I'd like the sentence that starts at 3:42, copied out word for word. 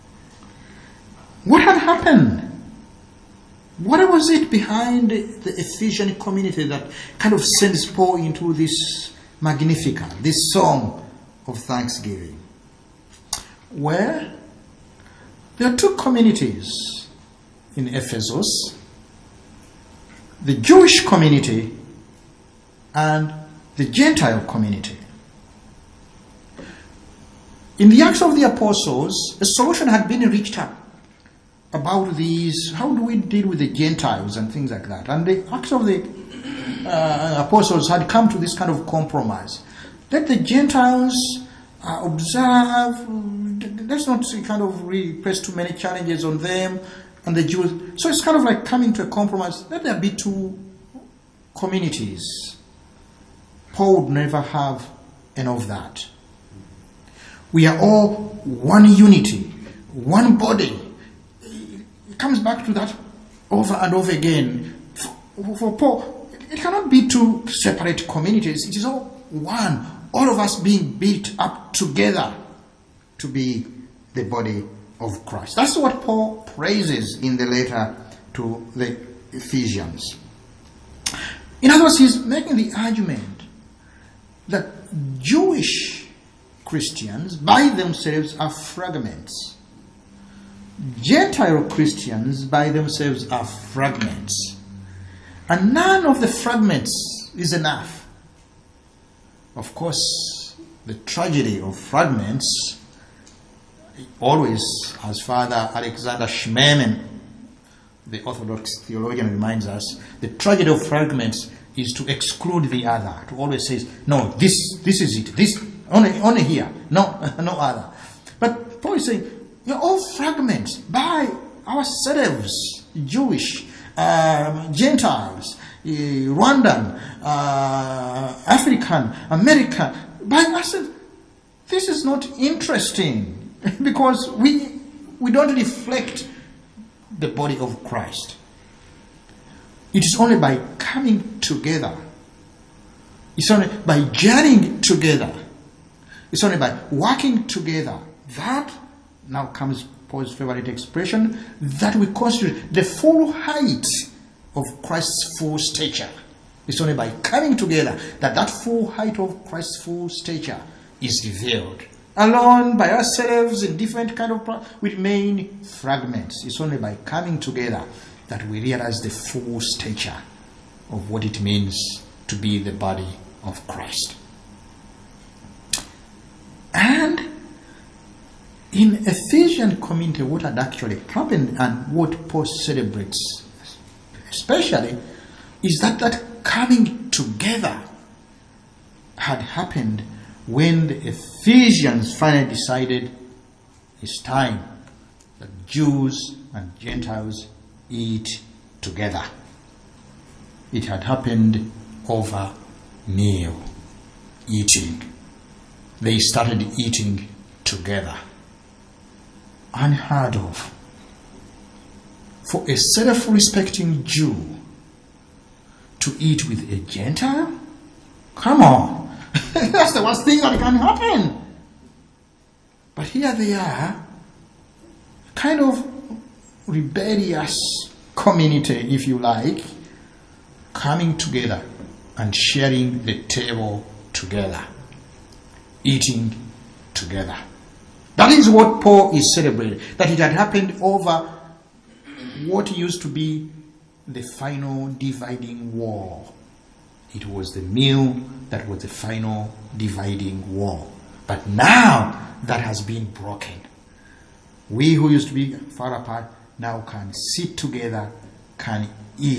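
But here they are, kind of rebellious community, if you like, coming together and sharing the table together, eating together.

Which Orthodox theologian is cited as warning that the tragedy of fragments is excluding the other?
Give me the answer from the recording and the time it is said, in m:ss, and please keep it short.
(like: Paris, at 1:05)
Alexander Schmemann, at 1:45.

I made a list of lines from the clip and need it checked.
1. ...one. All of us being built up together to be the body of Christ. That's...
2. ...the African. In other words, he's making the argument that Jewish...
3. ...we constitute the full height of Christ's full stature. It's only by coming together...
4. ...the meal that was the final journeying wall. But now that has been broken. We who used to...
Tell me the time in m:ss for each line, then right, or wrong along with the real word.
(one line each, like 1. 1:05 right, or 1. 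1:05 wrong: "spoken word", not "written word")
1. 1:09 right
2. 1:18 wrong: "Ephesians", not "African"
3. 2:31 right
4. 4:07 wrong: "dividing", not "journeying".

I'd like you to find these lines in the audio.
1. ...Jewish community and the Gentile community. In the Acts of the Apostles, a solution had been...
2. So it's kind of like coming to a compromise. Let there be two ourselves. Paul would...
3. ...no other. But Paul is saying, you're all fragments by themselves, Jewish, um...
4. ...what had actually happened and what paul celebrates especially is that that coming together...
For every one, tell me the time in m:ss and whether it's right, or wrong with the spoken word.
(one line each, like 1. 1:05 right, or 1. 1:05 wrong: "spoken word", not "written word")
1. 0:20 right
2. 0:48 wrong: "communities", not "ourselves"
3. 1:57 wrong: "ourselves", not "themselves"
4. 3:00 right.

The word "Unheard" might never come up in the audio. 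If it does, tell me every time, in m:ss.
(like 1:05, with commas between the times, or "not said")
3:29.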